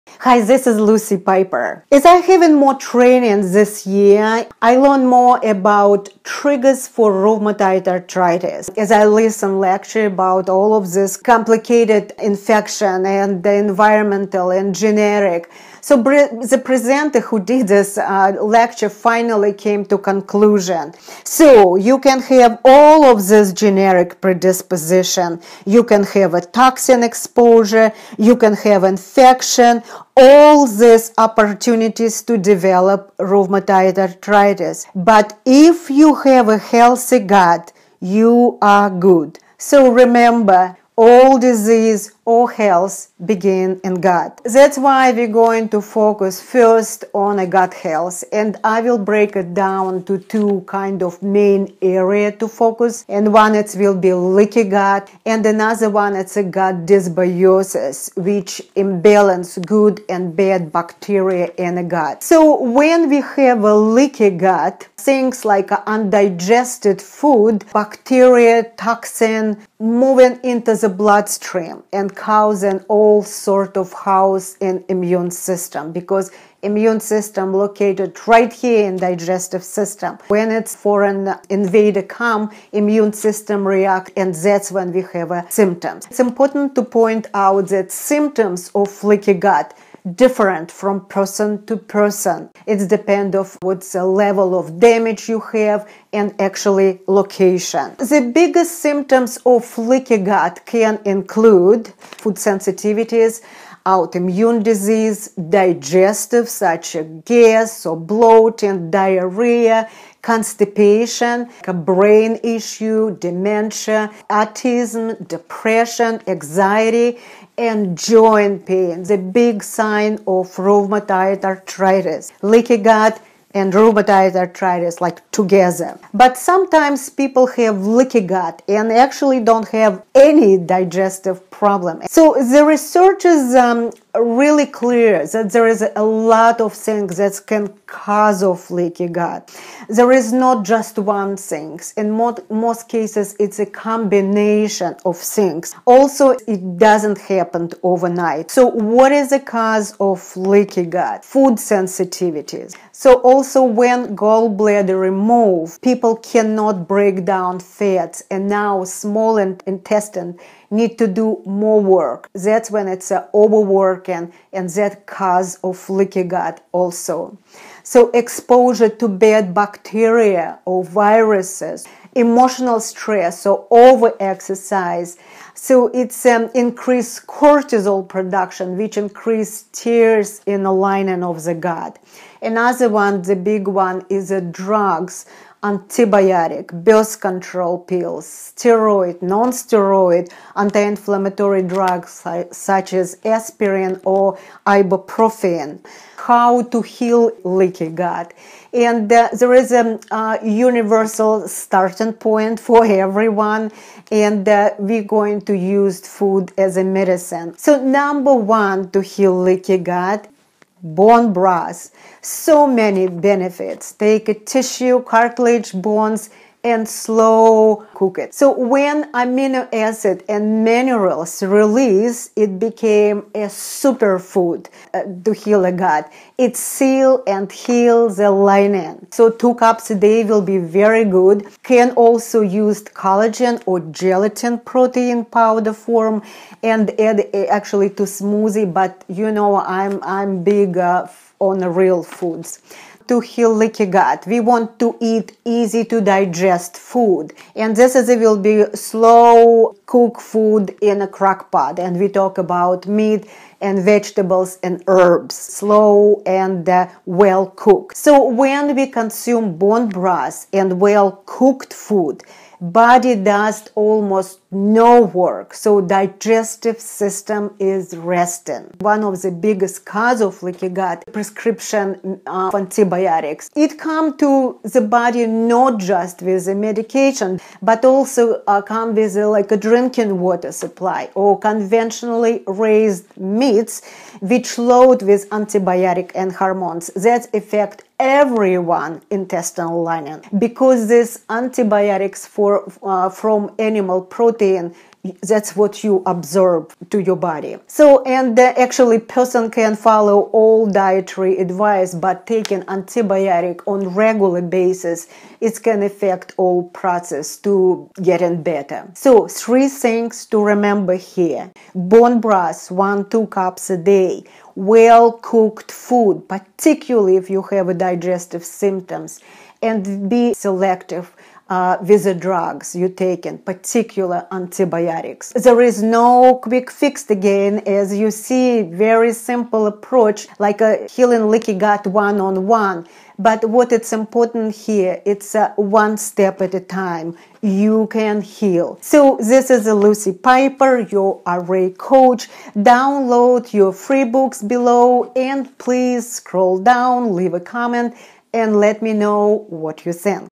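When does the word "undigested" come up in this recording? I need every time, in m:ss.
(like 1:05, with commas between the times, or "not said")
1:05.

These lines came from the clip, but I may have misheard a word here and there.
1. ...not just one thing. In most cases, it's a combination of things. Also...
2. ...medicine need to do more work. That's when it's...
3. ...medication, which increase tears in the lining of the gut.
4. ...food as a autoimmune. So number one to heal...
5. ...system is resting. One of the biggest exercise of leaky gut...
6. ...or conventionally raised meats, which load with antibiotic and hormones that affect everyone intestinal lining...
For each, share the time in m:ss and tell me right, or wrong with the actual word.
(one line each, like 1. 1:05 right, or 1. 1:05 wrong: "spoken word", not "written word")
1. 2:20 right
2. 2:39 wrong: "intestine", not "medicine"
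3. 2:58 wrong: "production", not "medication"
4. 3:26 wrong: "medicine", not "autoimmune"
5. 4:26 wrong: "cause", not "exercise"
6. 4:41 right.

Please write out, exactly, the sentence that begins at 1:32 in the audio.
It depends of what's the level of damage you have and actually location.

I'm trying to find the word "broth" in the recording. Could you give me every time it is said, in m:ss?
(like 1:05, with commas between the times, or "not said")
3:31, 4:19, 5:12.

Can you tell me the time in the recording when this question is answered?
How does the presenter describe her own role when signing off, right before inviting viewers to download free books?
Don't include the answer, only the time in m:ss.
5:41.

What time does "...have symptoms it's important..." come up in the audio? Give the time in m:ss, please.
1:25.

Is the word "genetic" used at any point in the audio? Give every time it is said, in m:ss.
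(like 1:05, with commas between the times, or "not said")
0:14, 0:23.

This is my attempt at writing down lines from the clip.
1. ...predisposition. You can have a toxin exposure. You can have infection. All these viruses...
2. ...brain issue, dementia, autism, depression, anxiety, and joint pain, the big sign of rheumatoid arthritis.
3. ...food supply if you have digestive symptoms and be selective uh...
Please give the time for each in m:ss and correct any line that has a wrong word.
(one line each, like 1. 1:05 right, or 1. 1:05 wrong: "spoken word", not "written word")
1. 0:24 wrong: "opportunities", not "viruses"
2. 1:51 right
3. 5:15 wrong: "particularly", not "supply".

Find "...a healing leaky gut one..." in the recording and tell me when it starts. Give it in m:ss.
5:30.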